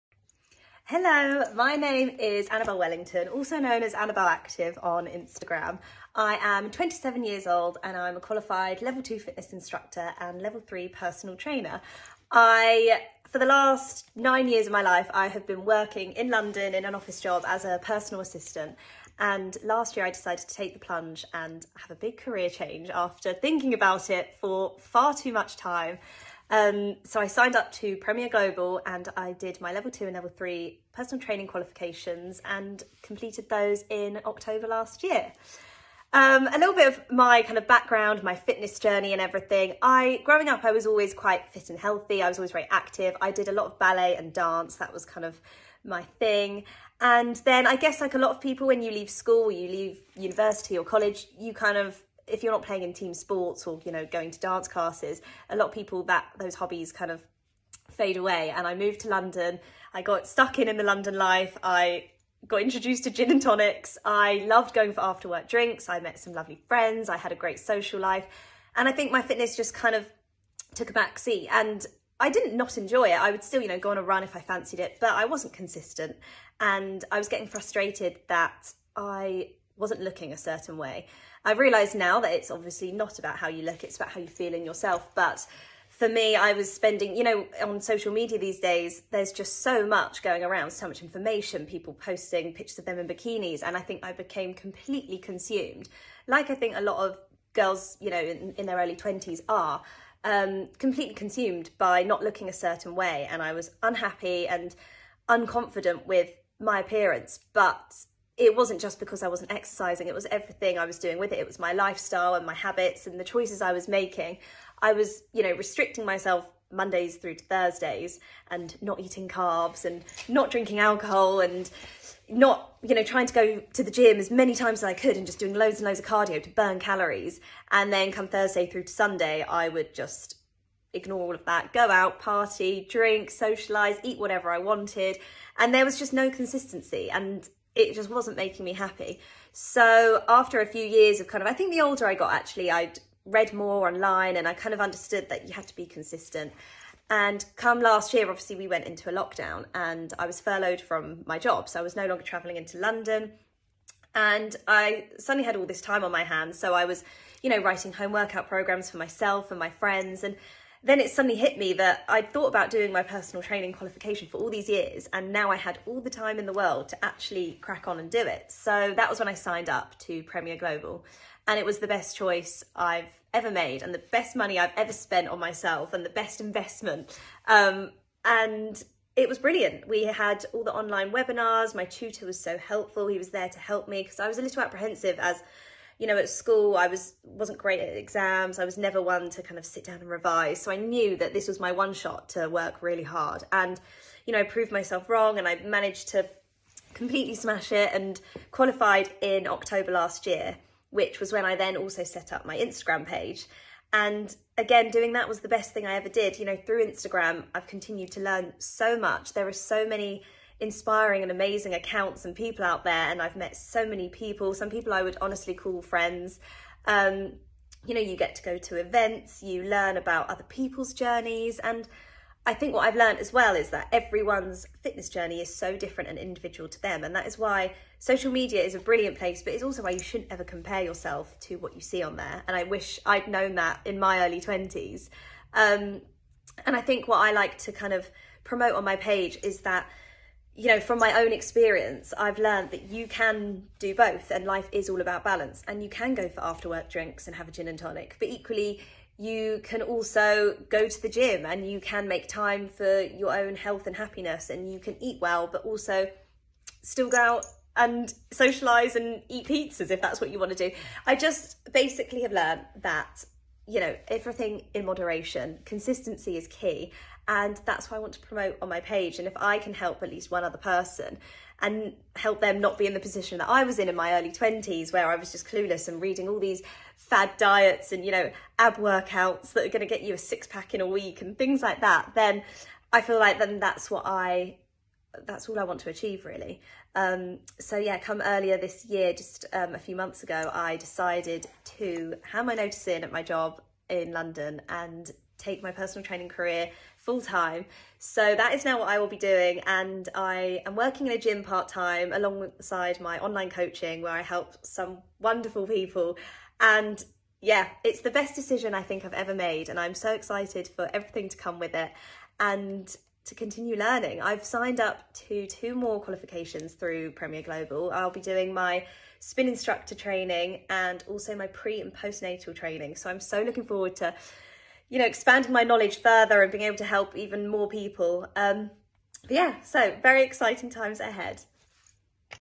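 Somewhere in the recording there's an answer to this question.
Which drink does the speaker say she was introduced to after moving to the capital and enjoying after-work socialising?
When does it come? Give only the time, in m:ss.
1:03.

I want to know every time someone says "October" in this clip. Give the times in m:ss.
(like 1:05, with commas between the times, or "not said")
0:34, 3:19.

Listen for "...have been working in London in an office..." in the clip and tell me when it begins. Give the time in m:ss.
0:15.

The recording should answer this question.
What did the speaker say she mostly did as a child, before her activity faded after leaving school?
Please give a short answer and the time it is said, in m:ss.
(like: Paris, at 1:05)
ballet and dance, at 0:43.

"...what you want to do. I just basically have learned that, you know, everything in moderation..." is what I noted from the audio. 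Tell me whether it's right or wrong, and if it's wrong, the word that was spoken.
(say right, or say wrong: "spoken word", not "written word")
right.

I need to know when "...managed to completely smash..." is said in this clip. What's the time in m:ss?
3:15.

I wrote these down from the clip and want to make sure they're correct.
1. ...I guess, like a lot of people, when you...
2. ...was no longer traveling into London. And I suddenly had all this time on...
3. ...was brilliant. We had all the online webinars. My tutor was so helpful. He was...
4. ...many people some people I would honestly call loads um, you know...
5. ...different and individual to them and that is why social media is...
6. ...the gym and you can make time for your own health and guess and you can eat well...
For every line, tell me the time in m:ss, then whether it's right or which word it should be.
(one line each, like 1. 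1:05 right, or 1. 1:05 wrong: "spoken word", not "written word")
1. 0:47 right
2. 2:31 right
3. 2:59 right
4. 3:33 wrong: "friends", not "loads"
5. 3:45 right
6. 4:11 wrong: "happiness", not "guess".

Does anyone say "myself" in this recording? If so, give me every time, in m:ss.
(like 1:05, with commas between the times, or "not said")
1:56, 2:38, 2:55, 3:14.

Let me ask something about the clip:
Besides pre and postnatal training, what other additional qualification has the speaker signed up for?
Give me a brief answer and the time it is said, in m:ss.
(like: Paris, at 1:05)
spin instructor training, at 5:19.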